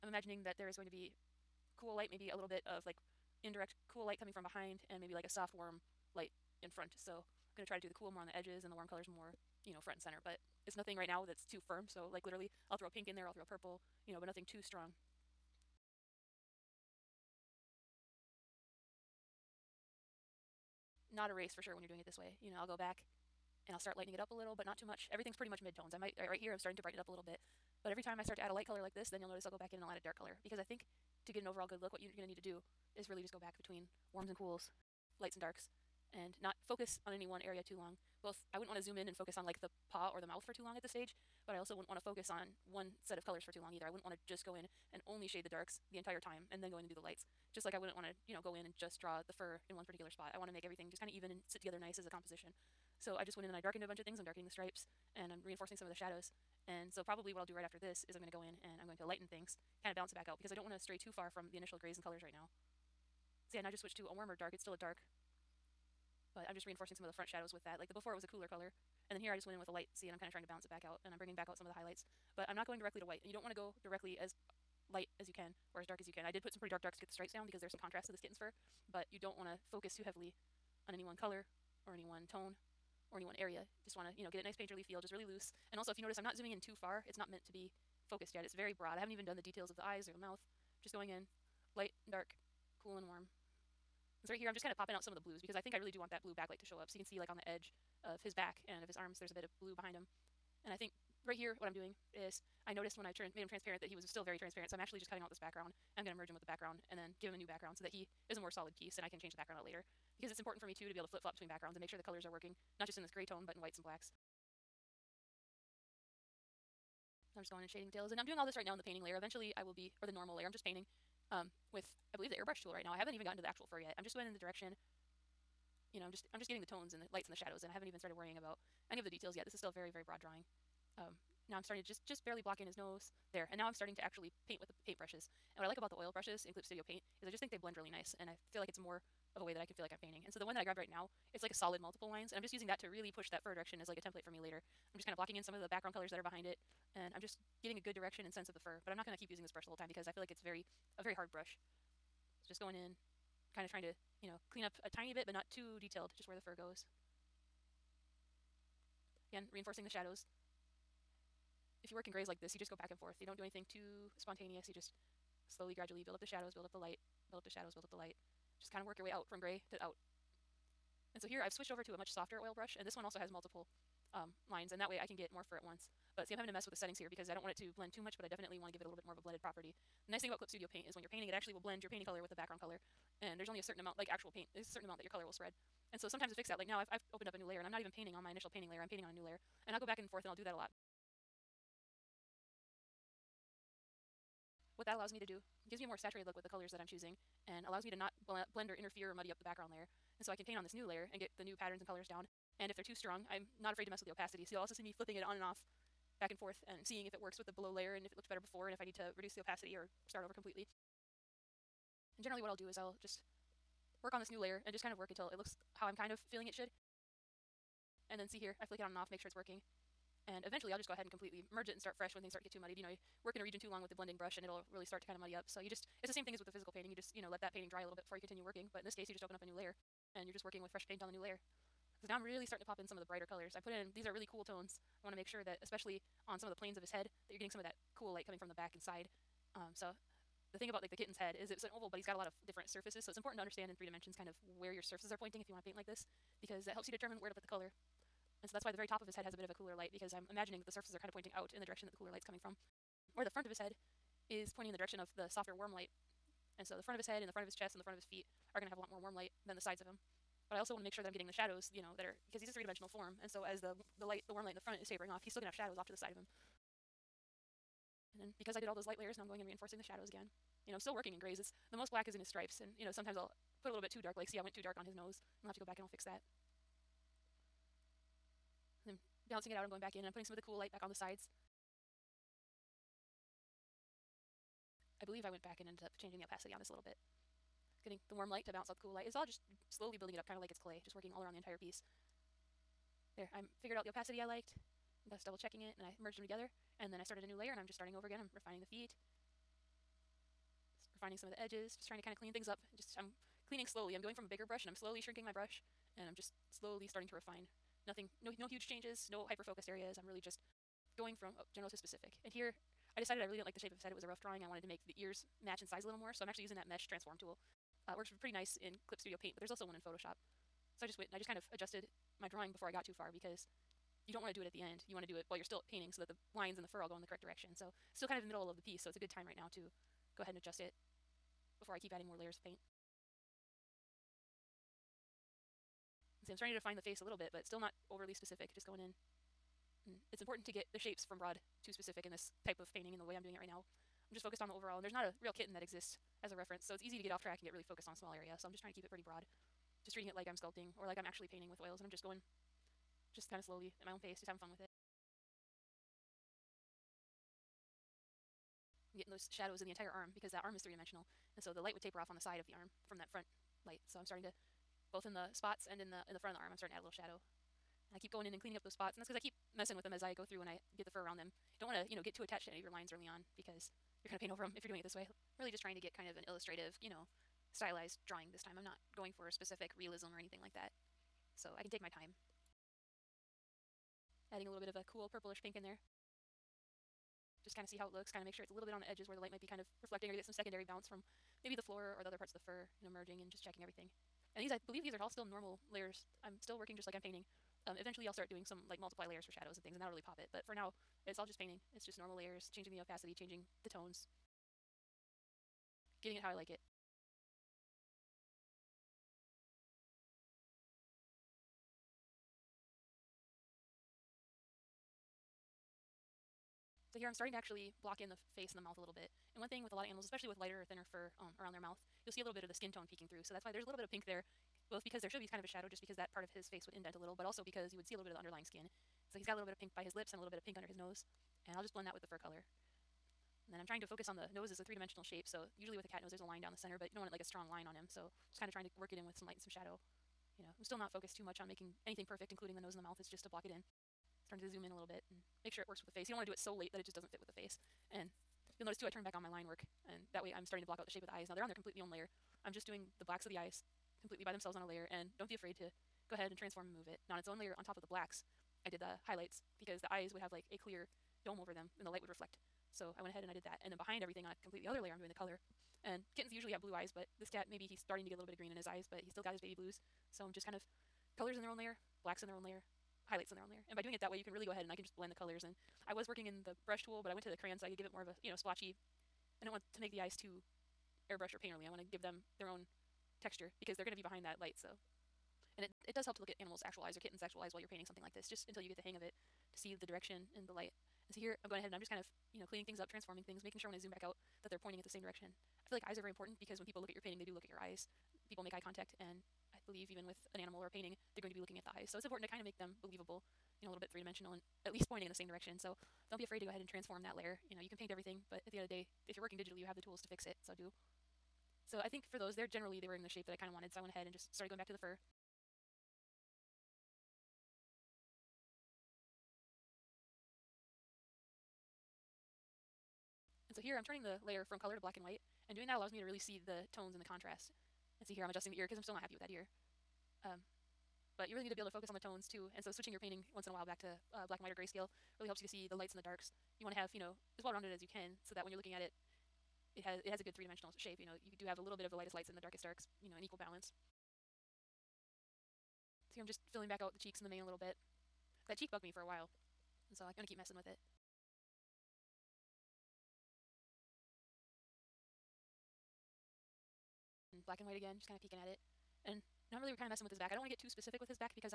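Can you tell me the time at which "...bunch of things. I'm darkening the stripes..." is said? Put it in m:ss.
0:53.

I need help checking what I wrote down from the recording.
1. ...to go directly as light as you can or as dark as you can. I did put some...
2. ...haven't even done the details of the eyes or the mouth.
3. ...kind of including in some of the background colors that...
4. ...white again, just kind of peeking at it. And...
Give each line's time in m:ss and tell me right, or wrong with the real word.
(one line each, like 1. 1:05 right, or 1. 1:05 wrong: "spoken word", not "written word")
1. 1:13 right
2. 1:28 right
3. 2:25 wrong: "blocking", not "including"
4. 9:17 right.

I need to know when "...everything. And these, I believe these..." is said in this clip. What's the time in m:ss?
6:33.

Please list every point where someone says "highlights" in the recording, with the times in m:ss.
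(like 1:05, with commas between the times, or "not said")
1:11, 7:39, 7:53.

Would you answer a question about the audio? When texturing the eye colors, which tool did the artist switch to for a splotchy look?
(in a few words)
crayon.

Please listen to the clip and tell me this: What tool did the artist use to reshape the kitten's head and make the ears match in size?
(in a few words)
mesh transform tool.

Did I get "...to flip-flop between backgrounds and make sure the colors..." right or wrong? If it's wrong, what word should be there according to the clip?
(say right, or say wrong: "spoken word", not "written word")
right.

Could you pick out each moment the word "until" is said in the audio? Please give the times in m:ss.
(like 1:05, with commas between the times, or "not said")
3:35, 8:08.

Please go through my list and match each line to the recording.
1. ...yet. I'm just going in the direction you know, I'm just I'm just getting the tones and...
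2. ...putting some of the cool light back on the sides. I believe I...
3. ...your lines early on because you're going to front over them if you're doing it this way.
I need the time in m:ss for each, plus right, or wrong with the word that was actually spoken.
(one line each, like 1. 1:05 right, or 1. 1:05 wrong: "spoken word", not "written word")
1. 2:03 right
2. 4:40 right
3. 6:12 wrong: "paint", not "front".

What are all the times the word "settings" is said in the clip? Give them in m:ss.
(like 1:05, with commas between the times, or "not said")
2:56.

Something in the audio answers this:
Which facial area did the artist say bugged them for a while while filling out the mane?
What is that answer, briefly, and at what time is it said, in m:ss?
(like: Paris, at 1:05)
cheek, at 9:08.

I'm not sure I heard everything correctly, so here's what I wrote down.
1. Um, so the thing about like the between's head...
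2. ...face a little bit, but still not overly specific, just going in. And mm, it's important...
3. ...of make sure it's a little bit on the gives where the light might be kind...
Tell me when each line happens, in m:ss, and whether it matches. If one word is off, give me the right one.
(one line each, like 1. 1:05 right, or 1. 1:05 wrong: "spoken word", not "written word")
1. 3:59 wrong: "kitten", not "between"
2. 5:36 right
3. 6:28 wrong: "edges", not "gives".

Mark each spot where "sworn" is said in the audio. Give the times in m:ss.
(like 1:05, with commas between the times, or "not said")
not said.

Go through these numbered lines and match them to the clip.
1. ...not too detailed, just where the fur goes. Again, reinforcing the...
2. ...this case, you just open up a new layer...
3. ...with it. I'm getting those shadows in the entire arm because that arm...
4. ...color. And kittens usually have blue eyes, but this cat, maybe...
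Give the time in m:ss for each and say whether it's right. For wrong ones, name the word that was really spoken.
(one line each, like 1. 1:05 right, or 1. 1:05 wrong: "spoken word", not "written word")
1. 2:35 right
2. 3:48 right
3. 5:54 right
4. 7:45 right.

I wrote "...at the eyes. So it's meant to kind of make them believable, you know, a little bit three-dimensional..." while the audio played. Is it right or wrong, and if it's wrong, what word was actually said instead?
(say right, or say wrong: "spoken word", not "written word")
wrong: "important", not "meant".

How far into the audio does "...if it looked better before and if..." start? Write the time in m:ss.
3:28.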